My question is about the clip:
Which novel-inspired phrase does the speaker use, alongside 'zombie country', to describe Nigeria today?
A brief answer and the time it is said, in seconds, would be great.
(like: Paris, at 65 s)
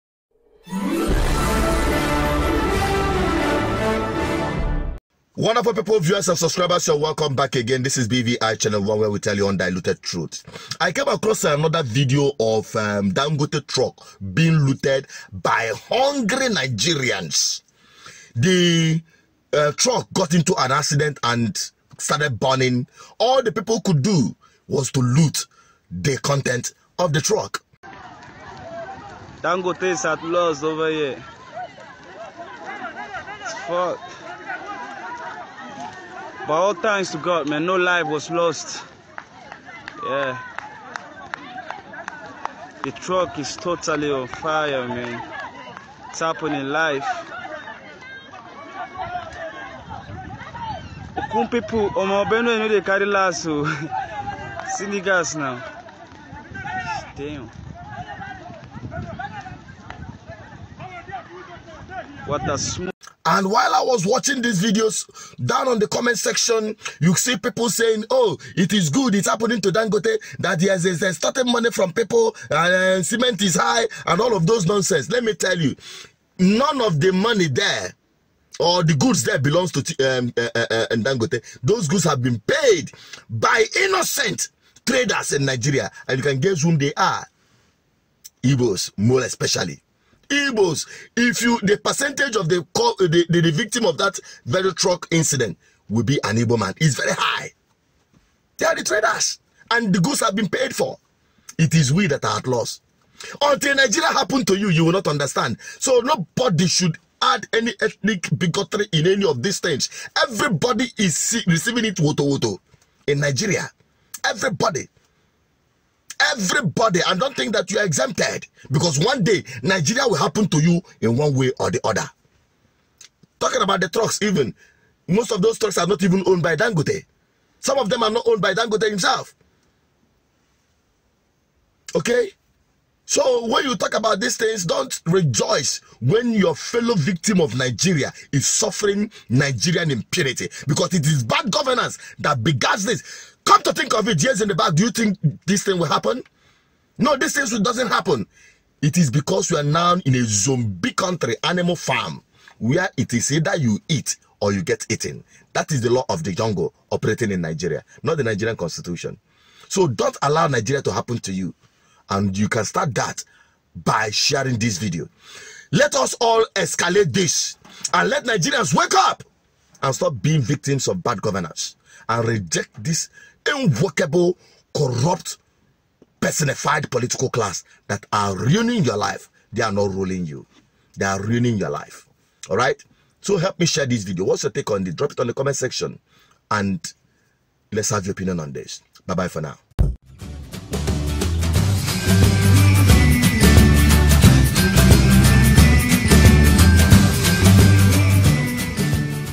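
animal farm, at 151 s.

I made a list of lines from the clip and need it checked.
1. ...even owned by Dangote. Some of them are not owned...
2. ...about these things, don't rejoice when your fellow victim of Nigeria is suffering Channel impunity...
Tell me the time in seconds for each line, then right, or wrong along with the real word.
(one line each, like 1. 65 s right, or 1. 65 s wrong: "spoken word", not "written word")
1. 126 s right
2. 133 s wrong: "Nigerian", not "Channel".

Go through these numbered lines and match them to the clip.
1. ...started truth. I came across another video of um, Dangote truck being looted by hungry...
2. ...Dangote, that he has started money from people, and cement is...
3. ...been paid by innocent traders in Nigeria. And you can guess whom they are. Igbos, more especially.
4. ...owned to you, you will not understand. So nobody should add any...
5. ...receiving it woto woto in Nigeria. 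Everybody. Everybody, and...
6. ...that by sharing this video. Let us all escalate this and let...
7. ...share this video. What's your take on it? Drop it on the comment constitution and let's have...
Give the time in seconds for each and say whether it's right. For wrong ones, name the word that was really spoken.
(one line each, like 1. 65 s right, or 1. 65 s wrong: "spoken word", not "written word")
1. 9 s wrong: "undiluted", not "started"
2. 69 s right
3. 82 s right
4. 104 s wrong: "happened", not "owned"
5. 111 s right
6. 162 s right
7. 183 s wrong: "section", not "constitution".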